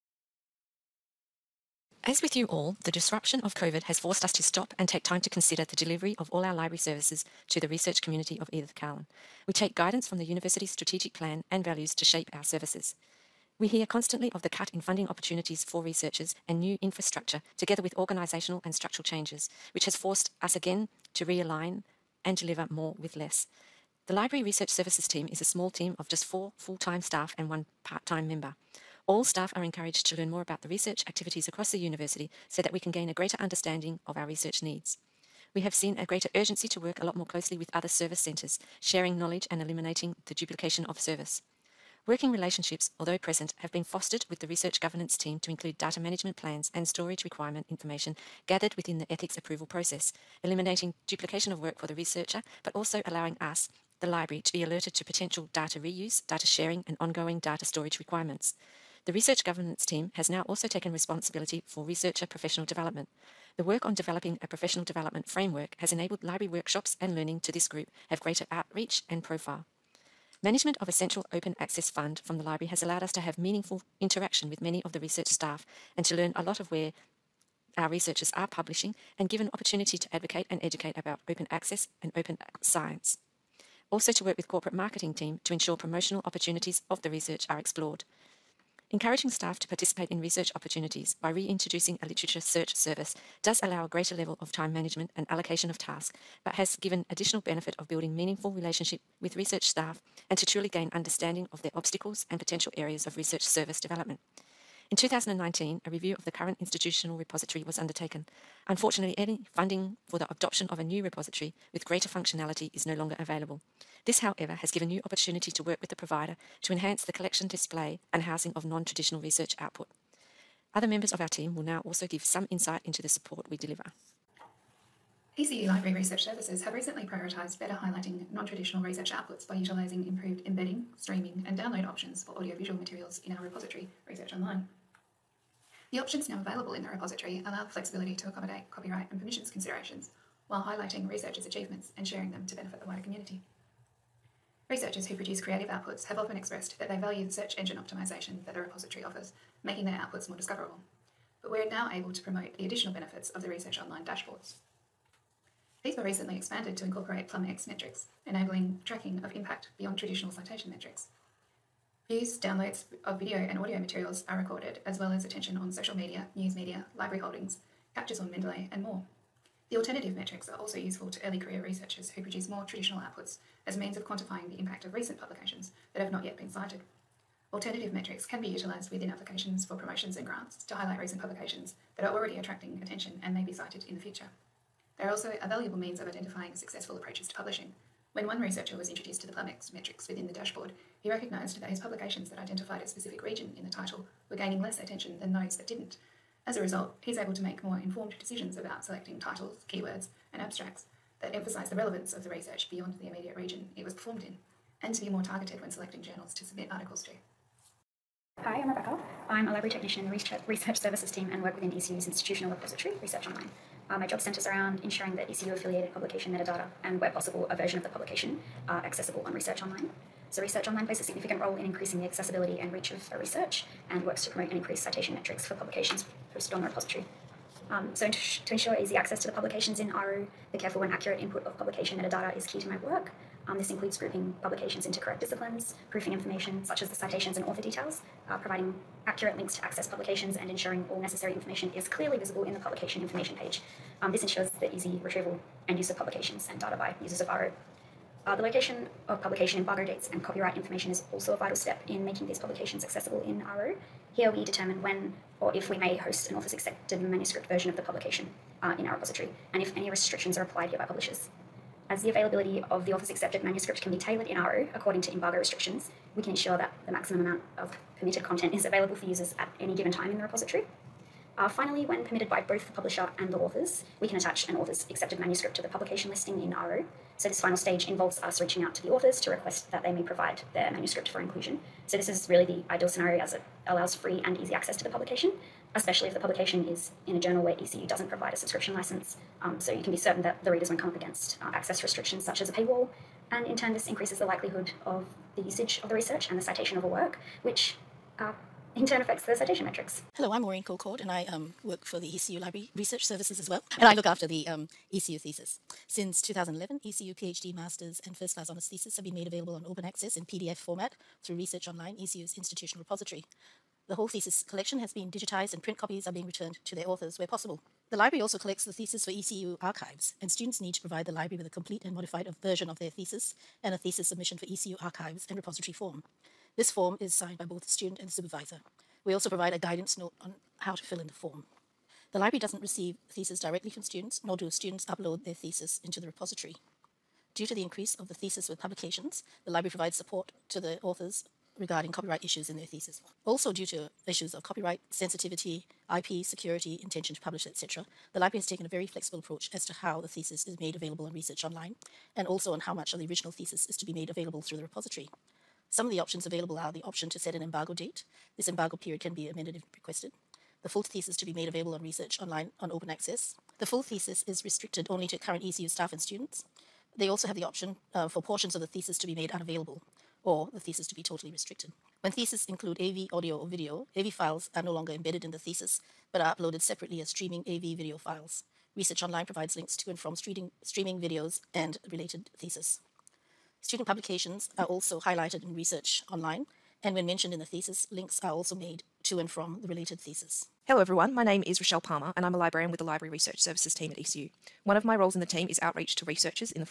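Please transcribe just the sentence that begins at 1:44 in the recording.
In 2019, a review of the current institutional repository was undertaken.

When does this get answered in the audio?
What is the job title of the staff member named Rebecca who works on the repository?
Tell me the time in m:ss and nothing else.
3:29.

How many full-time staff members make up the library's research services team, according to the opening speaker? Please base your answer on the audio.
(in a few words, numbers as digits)
4.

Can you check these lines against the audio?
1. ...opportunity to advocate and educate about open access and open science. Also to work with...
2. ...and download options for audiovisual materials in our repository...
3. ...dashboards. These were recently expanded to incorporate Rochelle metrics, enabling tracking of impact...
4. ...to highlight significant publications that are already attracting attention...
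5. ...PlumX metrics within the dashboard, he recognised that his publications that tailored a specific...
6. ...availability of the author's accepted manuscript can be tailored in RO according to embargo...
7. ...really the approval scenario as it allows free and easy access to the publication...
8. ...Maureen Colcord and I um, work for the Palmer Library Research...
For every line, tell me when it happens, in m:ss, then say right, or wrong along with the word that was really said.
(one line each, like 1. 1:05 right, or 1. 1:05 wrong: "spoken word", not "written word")
1. 1:19 right
2. 2:11 right
3. 2:34 wrong: "PlumX", not "Rochelle"
4. 3:00 wrong: "recent", not "significant"
5. 3:09 wrong: "identified", not "tailored"
6. 4:22 right
7. 4:42 wrong: "ideal", not "approval"
8. 5:00 wrong: "ECU", not "Palmer".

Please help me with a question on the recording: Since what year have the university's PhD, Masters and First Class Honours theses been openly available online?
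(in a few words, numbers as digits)
2011.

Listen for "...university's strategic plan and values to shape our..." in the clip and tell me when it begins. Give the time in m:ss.
0:10.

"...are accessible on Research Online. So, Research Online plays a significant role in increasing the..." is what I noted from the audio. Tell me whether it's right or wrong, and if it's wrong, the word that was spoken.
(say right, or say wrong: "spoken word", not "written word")
right.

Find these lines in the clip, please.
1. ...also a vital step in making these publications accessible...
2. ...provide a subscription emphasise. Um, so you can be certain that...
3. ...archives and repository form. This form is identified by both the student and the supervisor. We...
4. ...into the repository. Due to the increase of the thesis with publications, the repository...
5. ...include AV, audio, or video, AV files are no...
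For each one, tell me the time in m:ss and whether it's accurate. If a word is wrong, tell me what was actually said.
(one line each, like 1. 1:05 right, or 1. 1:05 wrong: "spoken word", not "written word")
1. 4:11 right
2. 4:48 wrong: "license", not "emphasise"
3. 5:24 wrong: "signed", not "identified"
4. 5:35 wrong: "library", not "repository"
5. 6:12 right.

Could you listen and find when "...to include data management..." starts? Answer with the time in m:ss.
0:45.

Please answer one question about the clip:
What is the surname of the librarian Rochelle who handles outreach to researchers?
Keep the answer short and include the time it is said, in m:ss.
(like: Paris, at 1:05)
Palmer, at 6:31.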